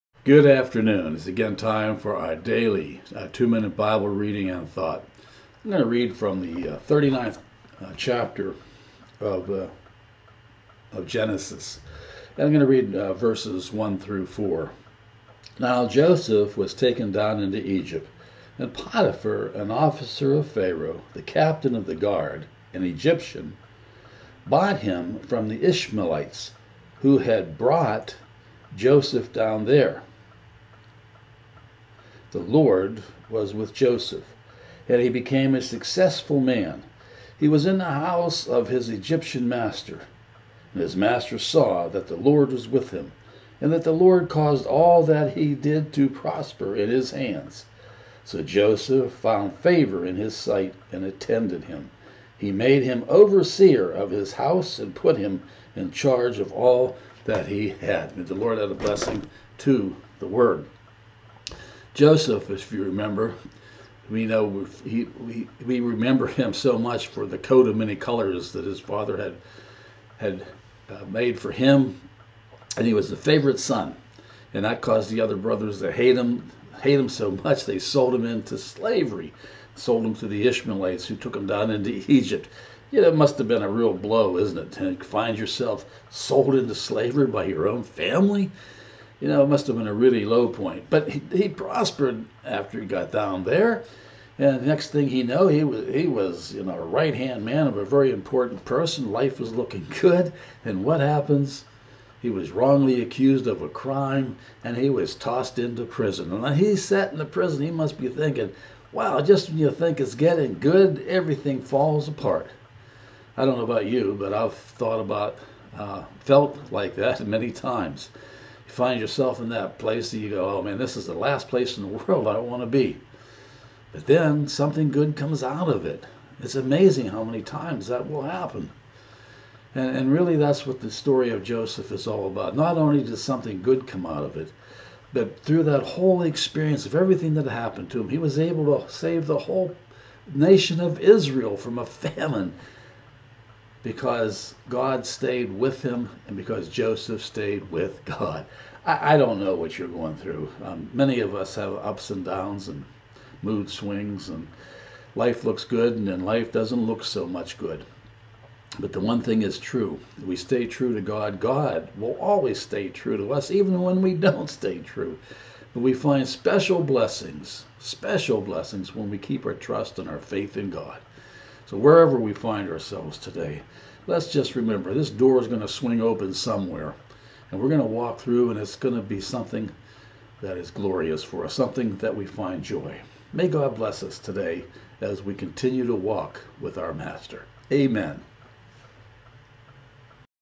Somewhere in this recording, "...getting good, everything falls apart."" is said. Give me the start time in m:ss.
1:50.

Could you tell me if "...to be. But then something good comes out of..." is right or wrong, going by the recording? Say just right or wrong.
right.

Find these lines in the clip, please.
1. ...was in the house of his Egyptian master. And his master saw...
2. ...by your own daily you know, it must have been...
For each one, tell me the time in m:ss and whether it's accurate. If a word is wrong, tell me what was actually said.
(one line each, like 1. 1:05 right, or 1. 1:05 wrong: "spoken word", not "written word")
1. 0:37 right
2. 1:27 wrong: "family", not "daily".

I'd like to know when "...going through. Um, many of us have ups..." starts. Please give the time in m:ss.
2:29.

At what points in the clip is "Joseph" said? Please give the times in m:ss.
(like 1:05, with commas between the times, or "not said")
0:15, 0:28, 0:33, 0:48, 1:01, 2:11, 2:26.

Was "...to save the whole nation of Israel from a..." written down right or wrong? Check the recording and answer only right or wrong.
right.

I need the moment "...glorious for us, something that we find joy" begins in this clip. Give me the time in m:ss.
3:00.